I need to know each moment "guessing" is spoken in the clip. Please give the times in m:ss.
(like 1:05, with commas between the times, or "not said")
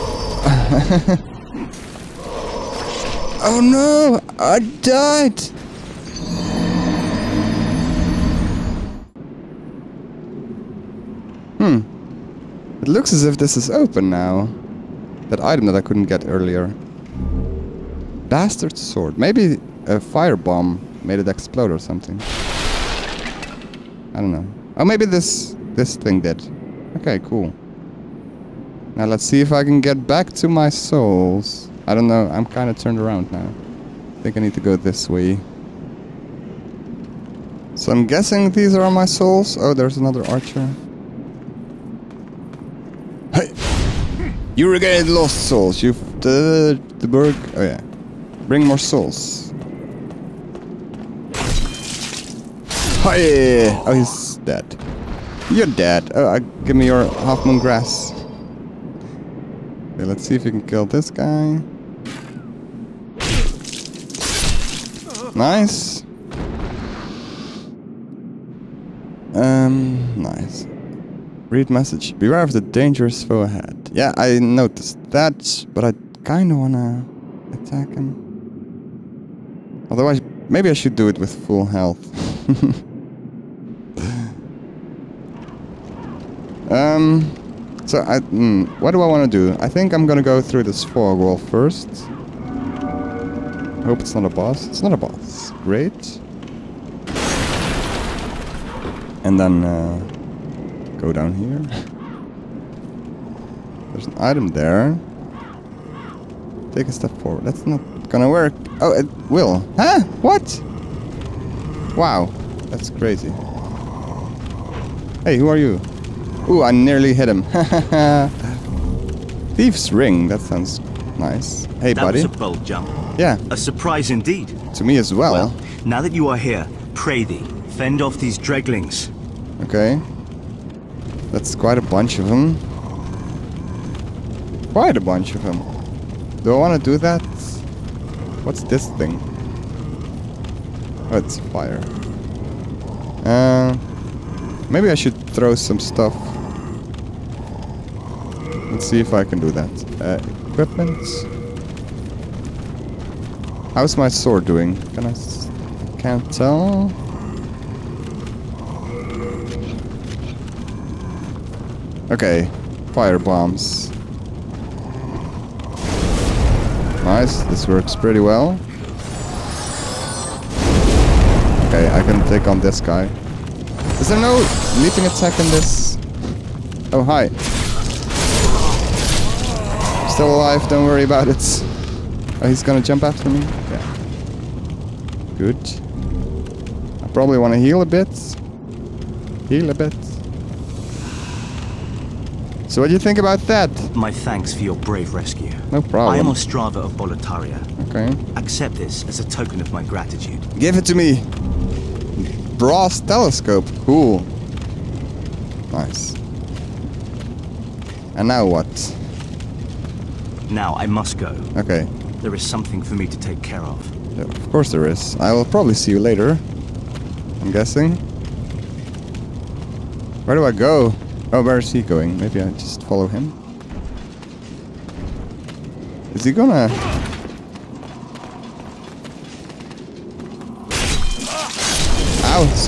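0:38, 3:37.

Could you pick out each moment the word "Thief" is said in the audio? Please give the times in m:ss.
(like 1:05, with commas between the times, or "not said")
1:59.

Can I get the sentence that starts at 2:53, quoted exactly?
Is there no leaping attack in this?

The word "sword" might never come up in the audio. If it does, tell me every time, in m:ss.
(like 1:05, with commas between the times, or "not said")
0:18, 2:34.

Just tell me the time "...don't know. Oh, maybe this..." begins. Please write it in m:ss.
0:24.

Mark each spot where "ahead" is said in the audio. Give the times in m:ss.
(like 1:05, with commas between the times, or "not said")
1:13.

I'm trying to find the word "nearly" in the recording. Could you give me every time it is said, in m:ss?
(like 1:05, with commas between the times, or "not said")
1:56.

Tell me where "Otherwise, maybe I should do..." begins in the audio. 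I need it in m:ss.
1:19.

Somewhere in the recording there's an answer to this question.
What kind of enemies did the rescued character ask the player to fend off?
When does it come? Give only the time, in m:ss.
2:08.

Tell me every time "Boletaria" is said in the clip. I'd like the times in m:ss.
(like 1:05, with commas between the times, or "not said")
3:16.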